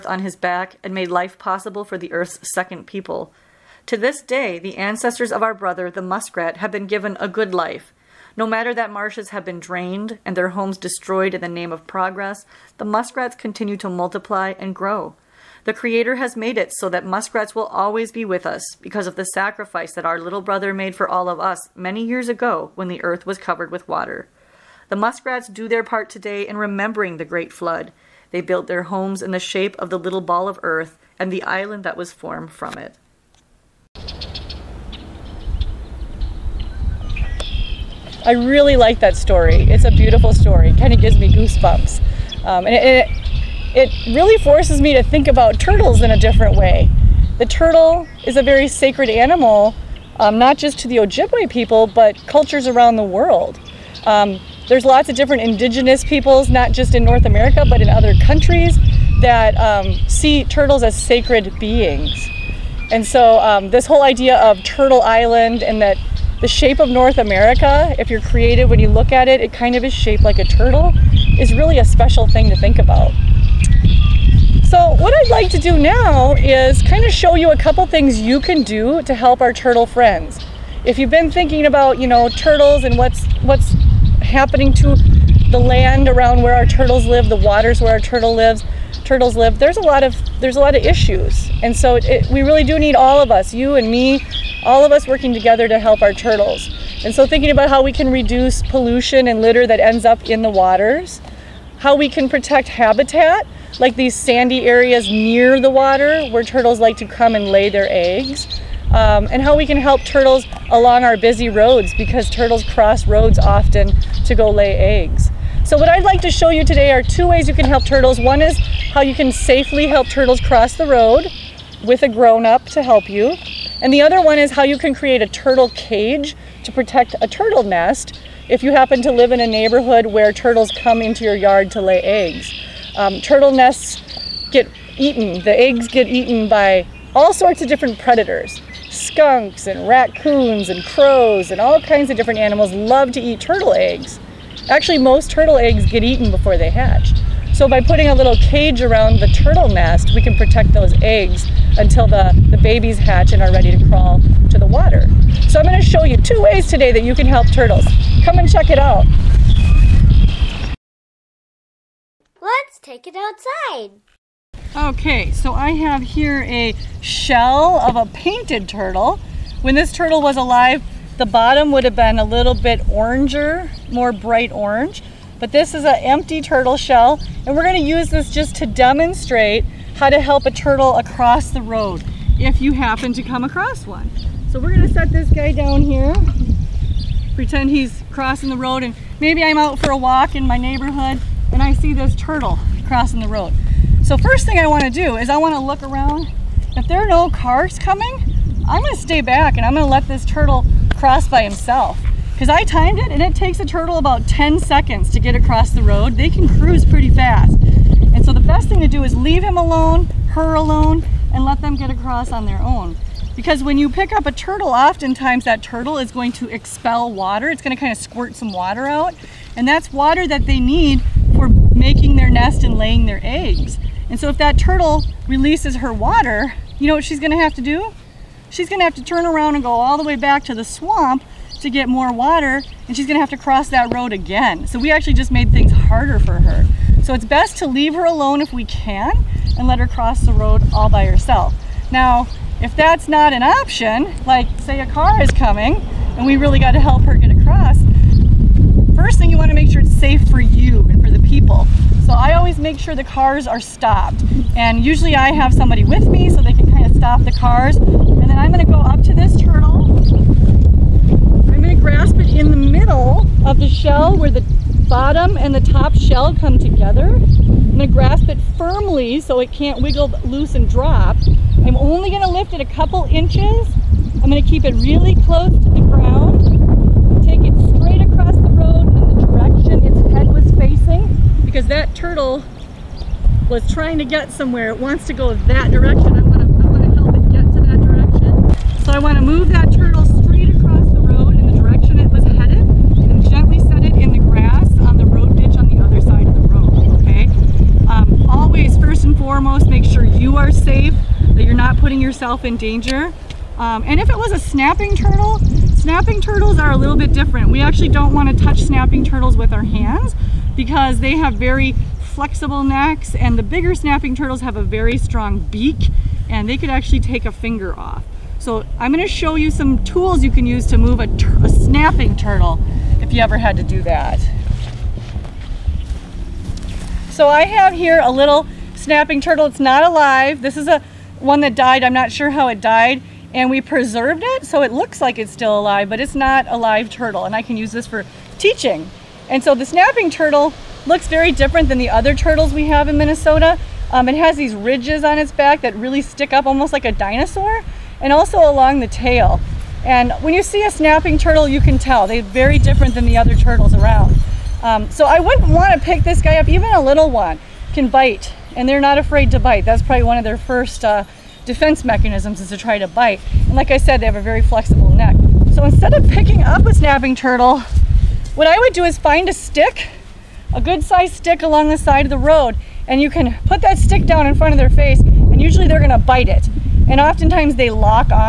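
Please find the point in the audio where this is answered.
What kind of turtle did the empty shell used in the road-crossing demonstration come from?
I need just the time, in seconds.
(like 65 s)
168 s.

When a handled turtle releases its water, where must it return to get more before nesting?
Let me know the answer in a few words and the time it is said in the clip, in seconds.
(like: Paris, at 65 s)
The swamp, at 230 s.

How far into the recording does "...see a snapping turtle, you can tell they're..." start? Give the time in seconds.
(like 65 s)
350 s.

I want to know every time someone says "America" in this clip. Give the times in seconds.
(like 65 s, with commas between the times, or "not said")
57 s, 67 s.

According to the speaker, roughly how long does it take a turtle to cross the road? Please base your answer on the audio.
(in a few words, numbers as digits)
10 seconds.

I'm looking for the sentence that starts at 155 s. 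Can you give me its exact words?
So I'm going to show you two ways today that you can help turtles.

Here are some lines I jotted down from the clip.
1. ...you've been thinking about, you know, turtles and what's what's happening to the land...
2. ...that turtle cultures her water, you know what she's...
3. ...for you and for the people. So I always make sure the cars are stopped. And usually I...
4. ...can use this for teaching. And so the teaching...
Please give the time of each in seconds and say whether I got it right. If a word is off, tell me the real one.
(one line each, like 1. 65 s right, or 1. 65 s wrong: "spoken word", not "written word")
1. 80 s right
2. 224 s wrong: "releases", not "cultures"
3. 250 s right
4. 337 s wrong: "snapping", not "teaching".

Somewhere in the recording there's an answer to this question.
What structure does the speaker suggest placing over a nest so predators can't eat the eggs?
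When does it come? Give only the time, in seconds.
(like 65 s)
125 s.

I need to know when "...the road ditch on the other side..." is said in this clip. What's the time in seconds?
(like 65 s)
294 s.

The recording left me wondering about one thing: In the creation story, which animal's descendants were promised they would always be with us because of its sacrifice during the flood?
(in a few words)
Muskrat.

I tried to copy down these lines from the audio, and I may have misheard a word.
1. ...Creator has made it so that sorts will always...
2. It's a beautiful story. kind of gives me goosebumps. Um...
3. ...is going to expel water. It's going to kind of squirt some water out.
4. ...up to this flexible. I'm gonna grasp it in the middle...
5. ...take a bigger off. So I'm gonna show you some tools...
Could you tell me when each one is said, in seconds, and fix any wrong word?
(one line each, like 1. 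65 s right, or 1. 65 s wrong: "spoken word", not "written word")
1. 15 s wrong: "muskrats", not "sorts"
2. 39 s right
3. 215 s right
4. 258 s wrong: "turtle", not "flexible"
5. 316 s wrong: "finger", not "bigger".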